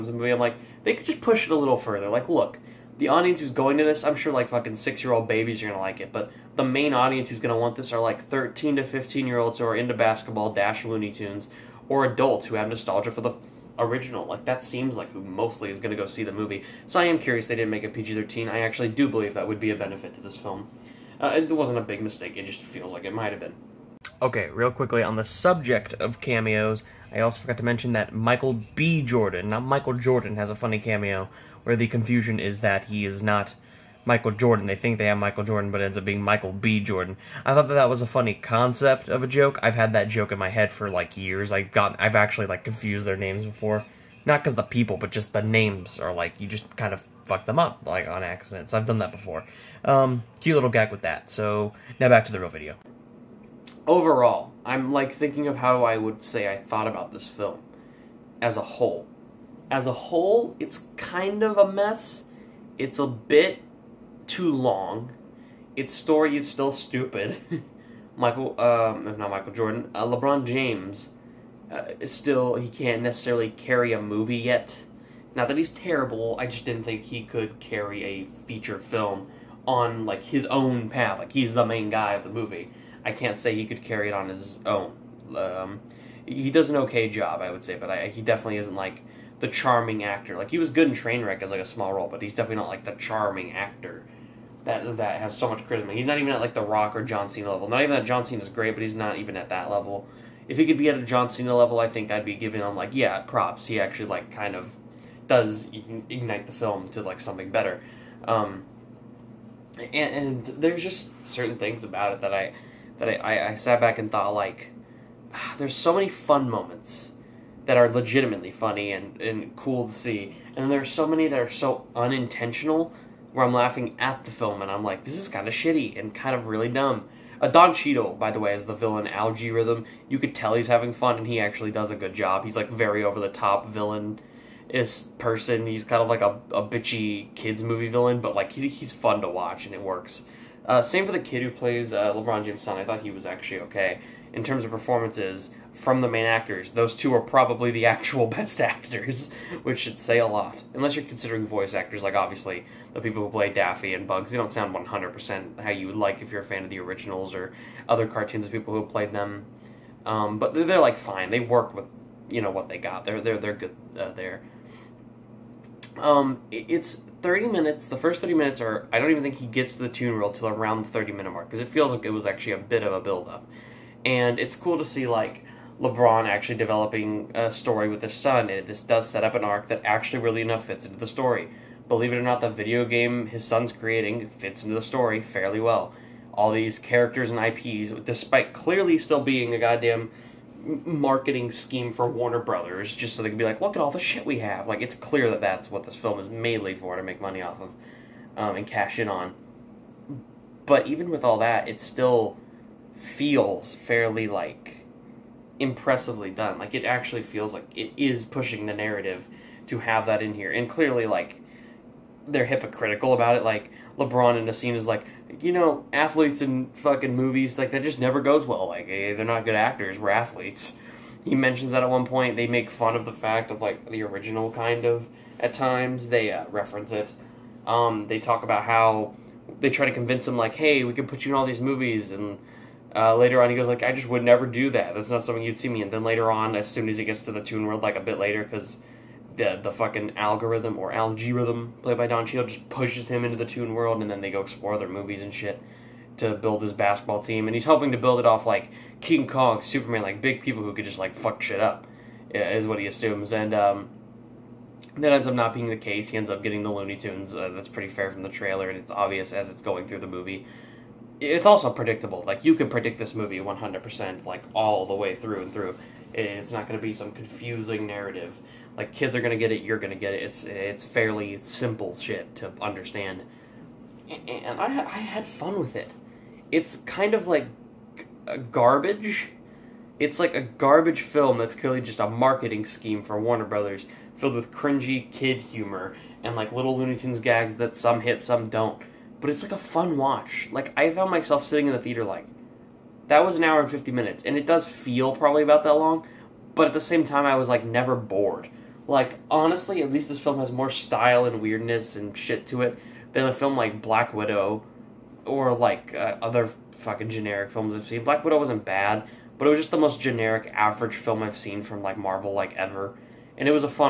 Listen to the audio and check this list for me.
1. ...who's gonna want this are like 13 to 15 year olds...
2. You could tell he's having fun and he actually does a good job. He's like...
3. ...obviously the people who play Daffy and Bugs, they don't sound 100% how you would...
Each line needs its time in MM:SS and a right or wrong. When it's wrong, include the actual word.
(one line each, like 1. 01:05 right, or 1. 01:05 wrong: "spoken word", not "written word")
1. 00:07 right
2. 02:10 right
3. 02:32 right.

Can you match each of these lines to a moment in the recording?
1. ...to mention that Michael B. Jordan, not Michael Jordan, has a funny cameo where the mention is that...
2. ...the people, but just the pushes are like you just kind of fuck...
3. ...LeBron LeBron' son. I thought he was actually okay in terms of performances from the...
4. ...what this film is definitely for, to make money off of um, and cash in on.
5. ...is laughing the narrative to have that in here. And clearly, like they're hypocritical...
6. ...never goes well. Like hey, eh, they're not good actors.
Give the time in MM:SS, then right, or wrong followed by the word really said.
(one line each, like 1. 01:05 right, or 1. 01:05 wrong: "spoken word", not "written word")
1. 00:27 wrong: "confusion", not "mention"
2. 00:44 wrong: "names", not "pushes"
3. 02:22 wrong: "James", not "LeBron"
4. 03:15 wrong: "mainly", not "definitely"
5. 03:27 wrong: "pushing", not "laughing"
6. 03:37 right.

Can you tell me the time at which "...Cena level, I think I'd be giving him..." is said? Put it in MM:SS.
01:41.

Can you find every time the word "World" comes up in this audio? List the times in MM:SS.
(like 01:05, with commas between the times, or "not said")
03:57, 04:03.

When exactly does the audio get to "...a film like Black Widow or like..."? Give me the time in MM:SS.
05:03.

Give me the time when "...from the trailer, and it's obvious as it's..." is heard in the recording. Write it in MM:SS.
04:18.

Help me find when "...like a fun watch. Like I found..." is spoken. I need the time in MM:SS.
04:49.